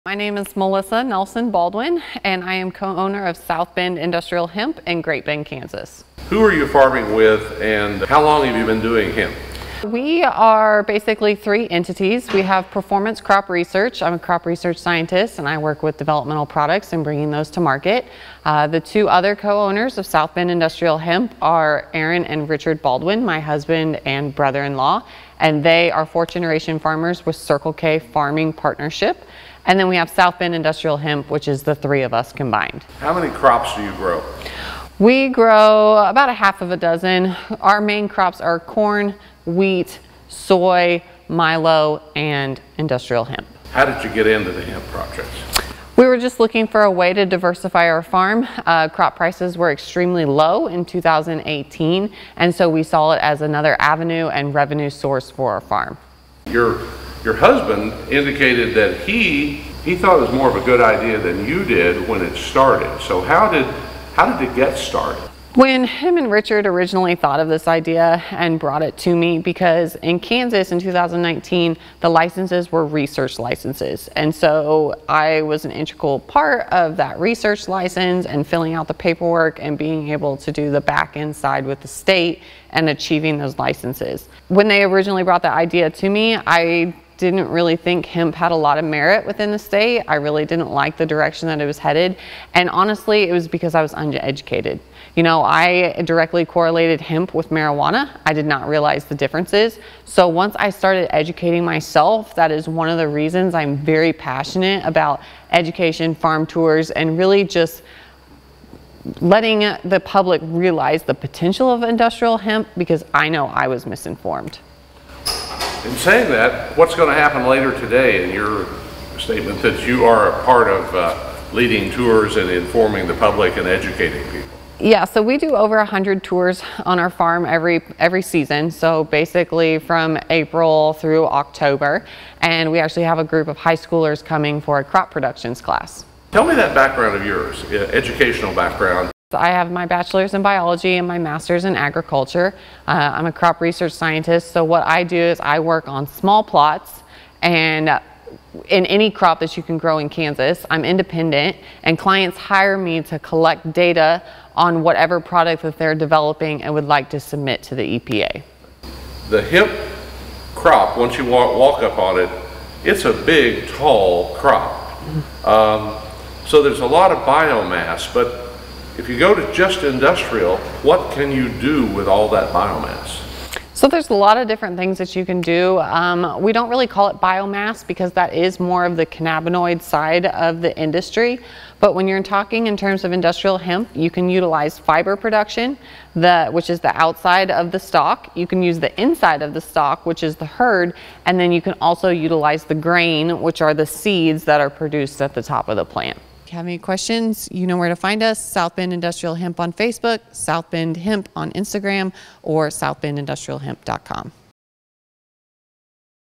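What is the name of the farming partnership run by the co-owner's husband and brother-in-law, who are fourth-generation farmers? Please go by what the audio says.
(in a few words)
Circle K Farming Partnership.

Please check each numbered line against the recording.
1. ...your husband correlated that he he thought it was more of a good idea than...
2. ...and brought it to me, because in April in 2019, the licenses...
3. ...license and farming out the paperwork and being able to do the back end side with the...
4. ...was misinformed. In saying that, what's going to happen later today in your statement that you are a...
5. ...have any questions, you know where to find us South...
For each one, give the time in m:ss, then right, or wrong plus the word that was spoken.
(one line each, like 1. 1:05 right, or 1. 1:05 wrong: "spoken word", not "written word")
1. 0:57 wrong: "indicated", not "correlated"
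2. 1:08 wrong: "Kansas", not "April"
3. 1:17 wrong: "filling", not "farming"
4. 1:53 right
5. 3:16 right.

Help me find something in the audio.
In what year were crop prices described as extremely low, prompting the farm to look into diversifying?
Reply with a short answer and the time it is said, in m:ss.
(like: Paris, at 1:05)
2018, at 0:50.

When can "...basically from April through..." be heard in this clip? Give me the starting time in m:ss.
2:09.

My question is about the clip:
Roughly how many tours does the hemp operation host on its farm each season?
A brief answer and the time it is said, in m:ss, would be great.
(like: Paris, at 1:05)
Over 100, at 2:05.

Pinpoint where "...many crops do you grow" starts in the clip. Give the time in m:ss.
0:33.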